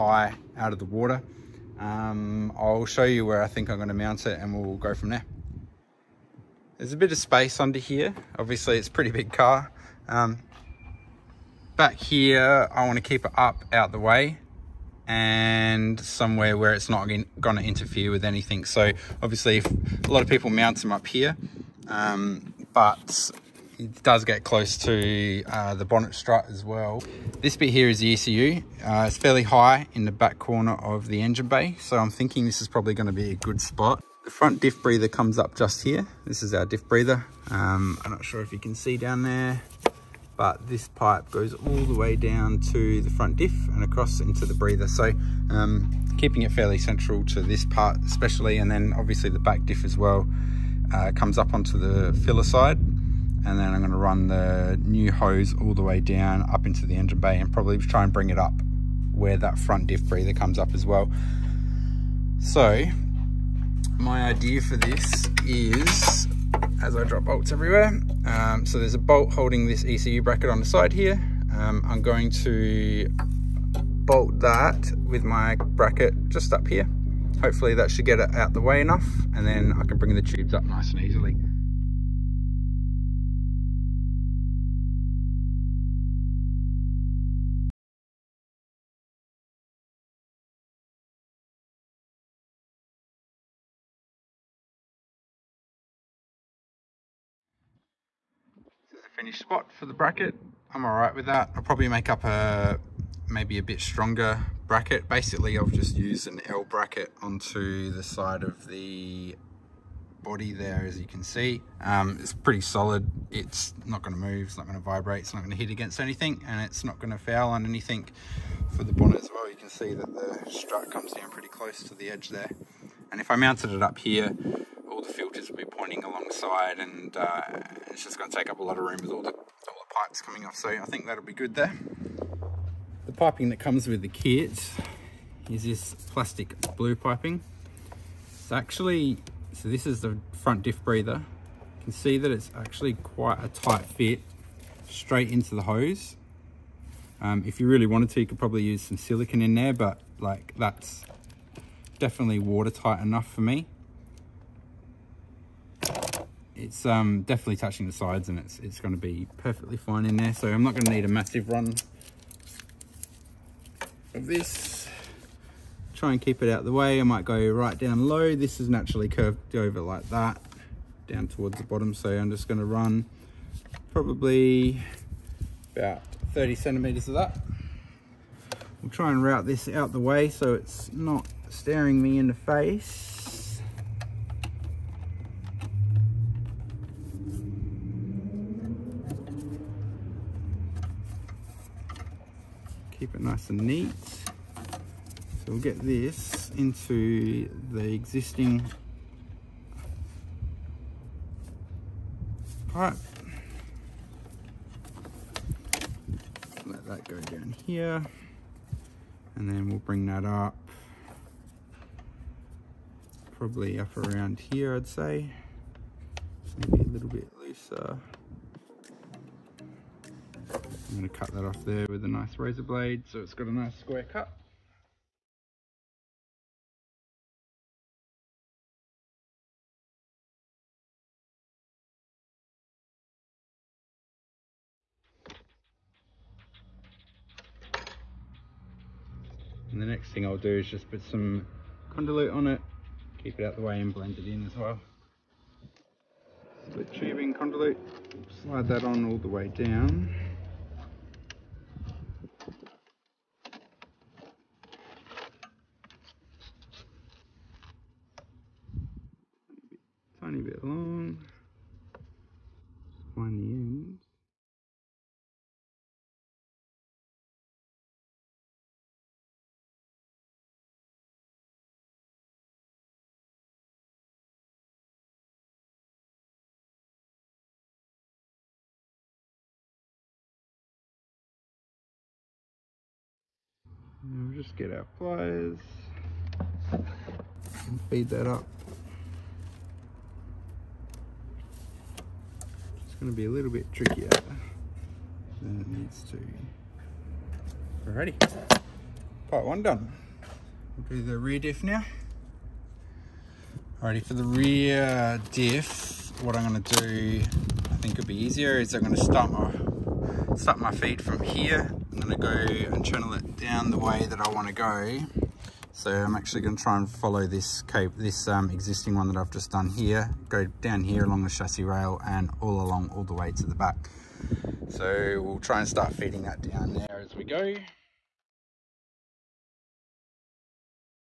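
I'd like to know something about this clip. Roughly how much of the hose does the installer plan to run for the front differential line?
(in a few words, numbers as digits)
30 centimeters.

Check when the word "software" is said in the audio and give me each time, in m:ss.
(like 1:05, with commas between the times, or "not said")
not said.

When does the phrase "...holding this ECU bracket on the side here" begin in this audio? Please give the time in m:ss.
1:09.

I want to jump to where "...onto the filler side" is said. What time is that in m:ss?
0:51.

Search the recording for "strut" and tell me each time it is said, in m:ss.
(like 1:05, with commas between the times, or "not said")
0:26, 2:00.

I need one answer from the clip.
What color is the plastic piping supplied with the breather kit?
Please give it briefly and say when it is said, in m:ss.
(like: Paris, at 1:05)
Blue, at 2:16.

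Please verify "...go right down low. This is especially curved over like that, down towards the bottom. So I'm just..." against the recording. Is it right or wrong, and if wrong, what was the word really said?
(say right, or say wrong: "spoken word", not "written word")
wrong: "naturally", not "especially".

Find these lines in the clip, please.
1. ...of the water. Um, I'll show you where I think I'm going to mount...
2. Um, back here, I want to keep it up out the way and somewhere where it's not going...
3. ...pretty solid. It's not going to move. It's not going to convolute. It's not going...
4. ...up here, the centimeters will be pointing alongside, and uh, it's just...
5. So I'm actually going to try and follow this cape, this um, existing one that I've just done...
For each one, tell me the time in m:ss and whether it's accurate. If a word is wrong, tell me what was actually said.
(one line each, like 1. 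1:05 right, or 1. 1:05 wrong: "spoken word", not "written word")
1. 0:00 right
2. 0:10 right
3. 1:52 wrong: "vibrate", not "convolute"
4. 2:03 wrong: "filters", not "centimeters"
5. 5:15 right.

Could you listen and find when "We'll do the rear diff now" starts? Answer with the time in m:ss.
5:00.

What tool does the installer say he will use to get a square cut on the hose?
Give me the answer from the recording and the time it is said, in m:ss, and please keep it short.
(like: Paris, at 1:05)
Razor blade, at 3:42.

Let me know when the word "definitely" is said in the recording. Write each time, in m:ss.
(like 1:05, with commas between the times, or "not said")
2:31, 2:37.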